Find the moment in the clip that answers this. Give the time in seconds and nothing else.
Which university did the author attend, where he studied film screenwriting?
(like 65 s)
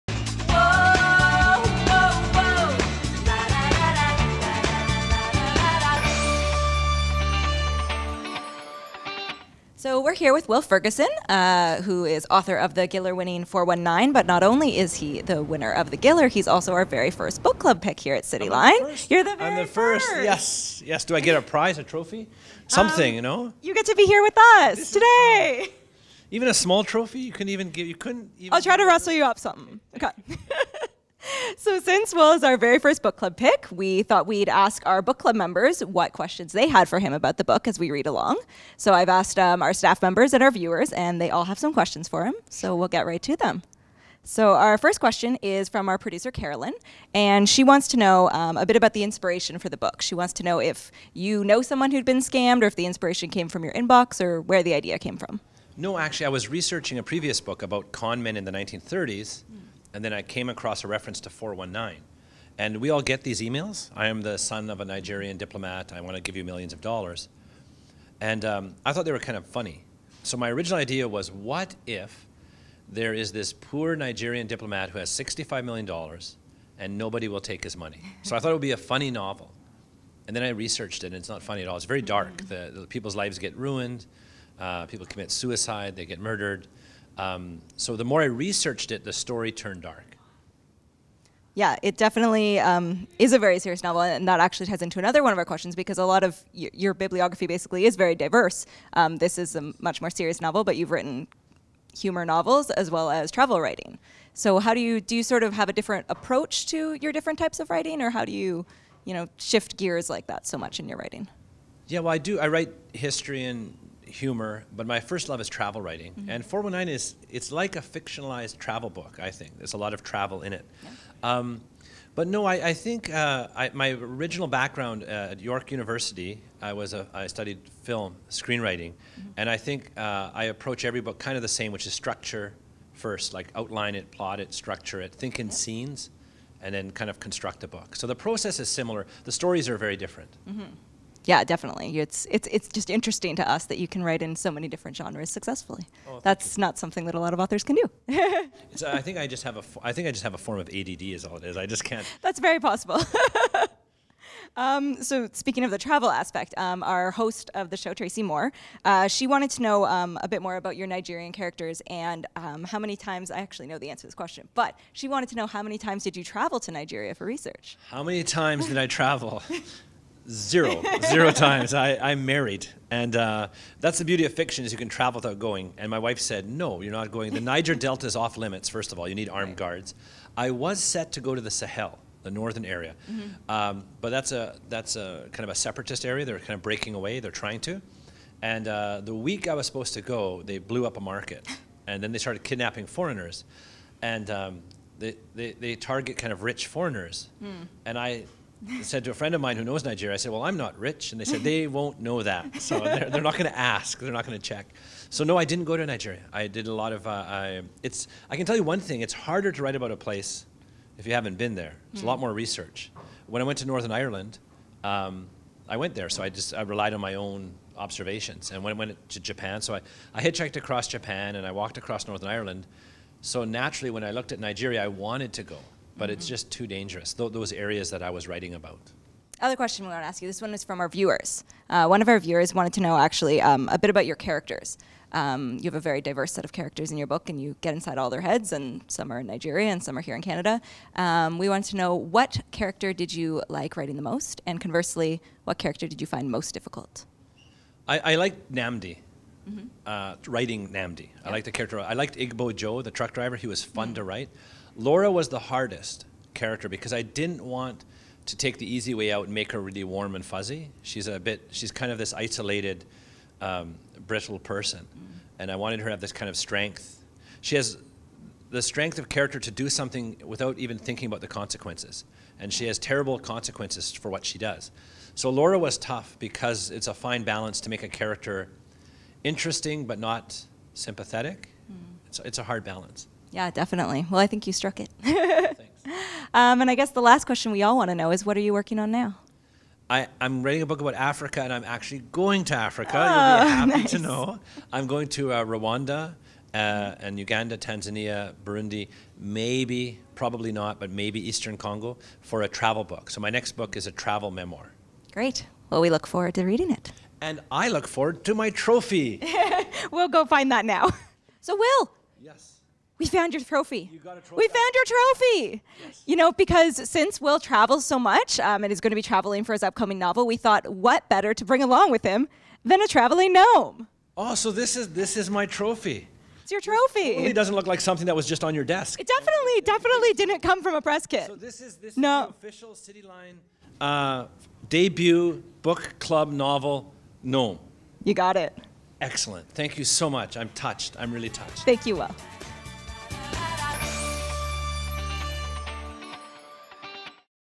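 125 s.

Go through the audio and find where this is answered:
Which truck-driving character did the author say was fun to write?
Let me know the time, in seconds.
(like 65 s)
252 s.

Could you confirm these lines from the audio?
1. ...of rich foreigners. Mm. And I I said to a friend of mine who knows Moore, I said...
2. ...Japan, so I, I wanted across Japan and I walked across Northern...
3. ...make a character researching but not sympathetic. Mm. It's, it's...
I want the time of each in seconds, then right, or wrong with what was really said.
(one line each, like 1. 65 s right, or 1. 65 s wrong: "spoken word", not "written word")
1. 196 s wrong: "Nigeria", not "Moore"
2. 219 s wrong: "hitchhiked", not "wanted"
3. 277 s wrong: "interesting", not "researching".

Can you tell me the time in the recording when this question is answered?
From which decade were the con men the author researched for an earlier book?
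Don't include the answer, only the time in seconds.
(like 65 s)
58 s.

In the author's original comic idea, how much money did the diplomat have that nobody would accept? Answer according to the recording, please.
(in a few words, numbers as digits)
$65 million.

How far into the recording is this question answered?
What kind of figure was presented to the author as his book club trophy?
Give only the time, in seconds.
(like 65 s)
322 s.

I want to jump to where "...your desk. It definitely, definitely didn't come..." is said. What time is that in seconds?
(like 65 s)
328 s.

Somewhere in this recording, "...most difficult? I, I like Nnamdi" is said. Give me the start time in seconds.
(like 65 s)
246 s.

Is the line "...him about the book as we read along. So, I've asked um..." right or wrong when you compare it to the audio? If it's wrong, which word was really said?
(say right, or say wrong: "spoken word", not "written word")
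right.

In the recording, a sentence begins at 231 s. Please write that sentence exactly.
Uh, one of our viewers wanted to know actually um, a bit about your characters.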